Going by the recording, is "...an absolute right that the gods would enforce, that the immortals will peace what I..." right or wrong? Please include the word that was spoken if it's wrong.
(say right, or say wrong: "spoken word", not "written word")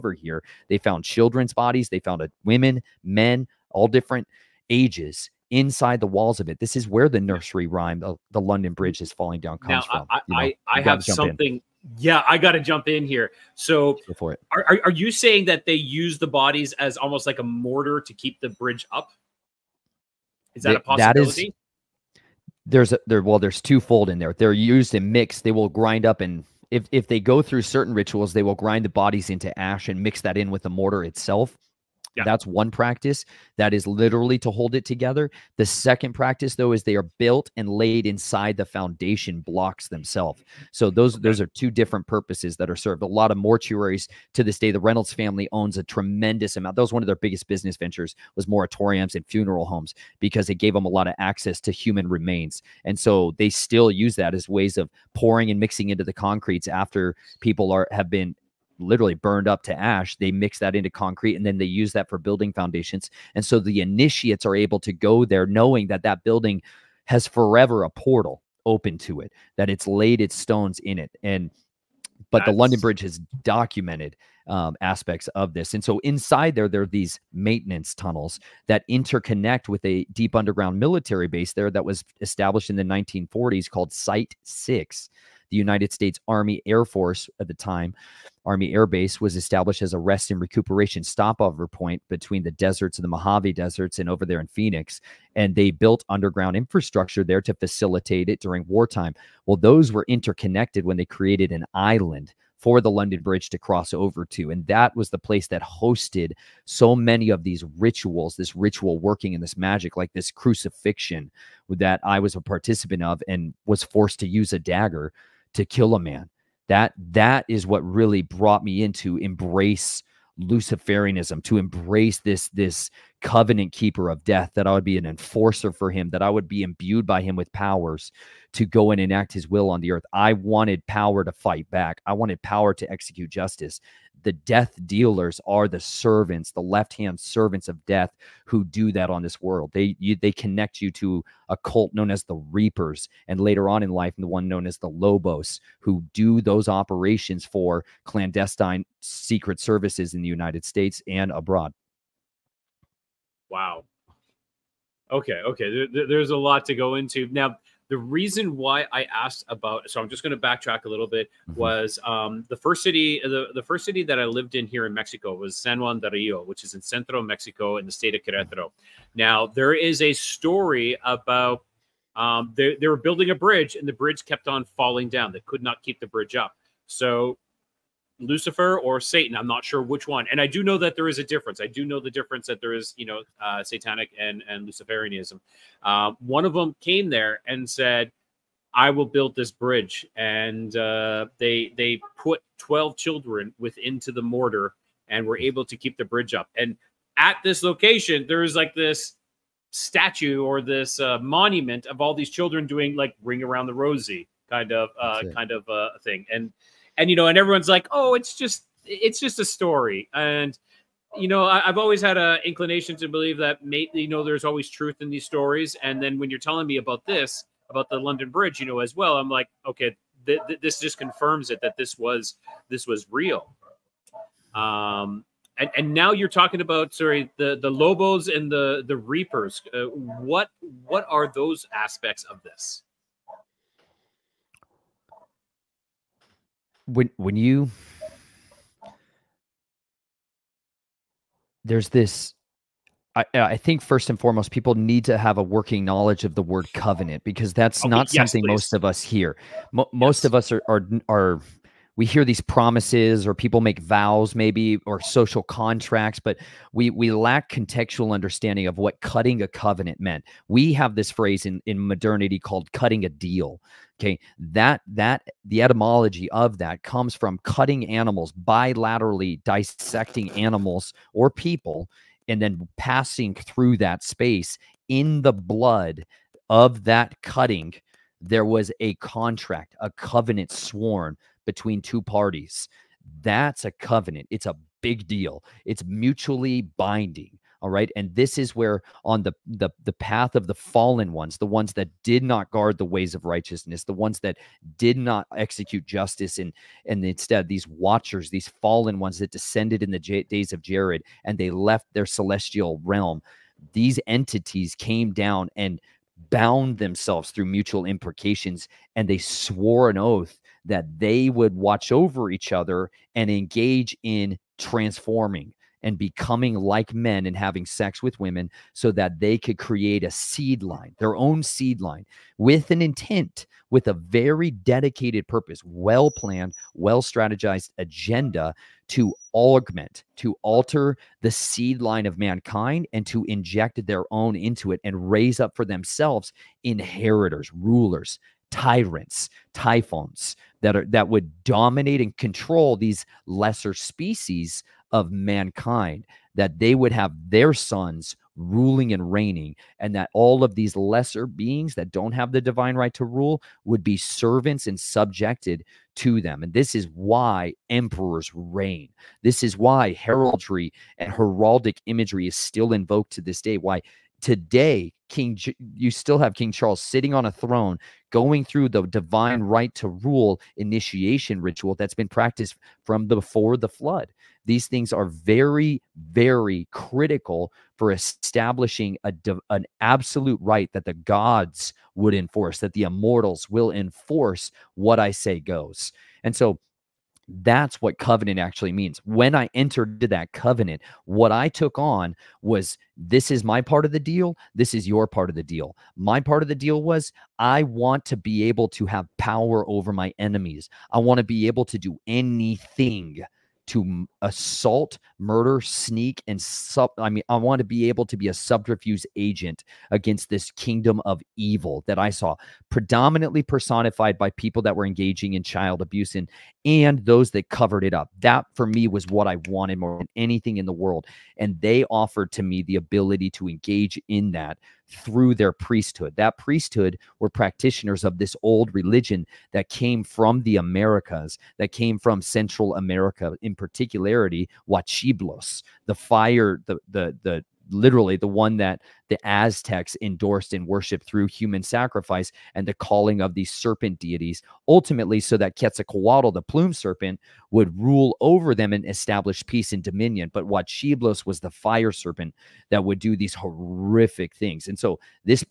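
wrong: "enforce", not "peace".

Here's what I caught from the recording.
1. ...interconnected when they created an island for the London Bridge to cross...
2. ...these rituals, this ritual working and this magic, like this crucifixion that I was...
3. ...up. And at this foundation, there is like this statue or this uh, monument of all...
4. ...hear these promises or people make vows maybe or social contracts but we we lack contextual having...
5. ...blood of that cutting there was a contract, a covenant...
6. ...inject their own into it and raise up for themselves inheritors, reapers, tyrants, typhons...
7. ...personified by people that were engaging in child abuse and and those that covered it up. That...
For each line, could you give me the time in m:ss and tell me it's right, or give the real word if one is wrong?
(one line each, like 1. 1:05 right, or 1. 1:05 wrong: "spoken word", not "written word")
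1. 1:40 right
2. 1:47 right
3. 3:16 wrong: "location", not "foundation"
4. 4:12 wrong: "understanding", not "having"
5. 4:35 right
6. 5:33 wrong: "rulers", not "reapers"
7. 6:53 right.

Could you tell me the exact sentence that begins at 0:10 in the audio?
I, you know, I, I have something.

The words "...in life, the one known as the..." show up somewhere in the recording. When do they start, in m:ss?
2:23.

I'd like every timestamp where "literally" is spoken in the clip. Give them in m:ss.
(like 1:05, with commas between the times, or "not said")
0:33, 0:58, 7:17.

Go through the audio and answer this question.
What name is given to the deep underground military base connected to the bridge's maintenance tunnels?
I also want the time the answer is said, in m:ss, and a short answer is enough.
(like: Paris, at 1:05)
Site 6, at 1:23.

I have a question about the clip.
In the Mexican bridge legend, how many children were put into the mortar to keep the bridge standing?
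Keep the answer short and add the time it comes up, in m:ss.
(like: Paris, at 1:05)
12, at 3:12.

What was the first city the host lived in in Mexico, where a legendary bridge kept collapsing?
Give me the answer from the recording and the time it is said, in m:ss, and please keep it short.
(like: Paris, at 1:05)
San Juan de Rio, at 2:45.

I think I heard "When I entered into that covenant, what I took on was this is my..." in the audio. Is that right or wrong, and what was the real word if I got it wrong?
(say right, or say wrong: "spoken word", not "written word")
right.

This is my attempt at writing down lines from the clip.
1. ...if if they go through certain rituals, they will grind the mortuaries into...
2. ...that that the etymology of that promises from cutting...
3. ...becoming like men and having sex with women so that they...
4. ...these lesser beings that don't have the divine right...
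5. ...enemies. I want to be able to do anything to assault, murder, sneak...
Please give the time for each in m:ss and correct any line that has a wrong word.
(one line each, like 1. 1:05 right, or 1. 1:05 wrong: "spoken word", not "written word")
1. 0:26 wrong: "bodies", not "mortuaries"
2. 4:24 wrong: "comes", not "promises"
3. 5:15 right
4. 5:50 right
5. 6:40 right.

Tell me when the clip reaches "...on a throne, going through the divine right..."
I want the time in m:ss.
6:07.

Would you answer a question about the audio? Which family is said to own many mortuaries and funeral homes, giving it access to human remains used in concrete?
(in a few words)
Reynolds.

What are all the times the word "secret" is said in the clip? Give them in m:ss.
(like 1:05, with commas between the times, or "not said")
2:28.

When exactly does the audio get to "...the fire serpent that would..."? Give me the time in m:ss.
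7:31.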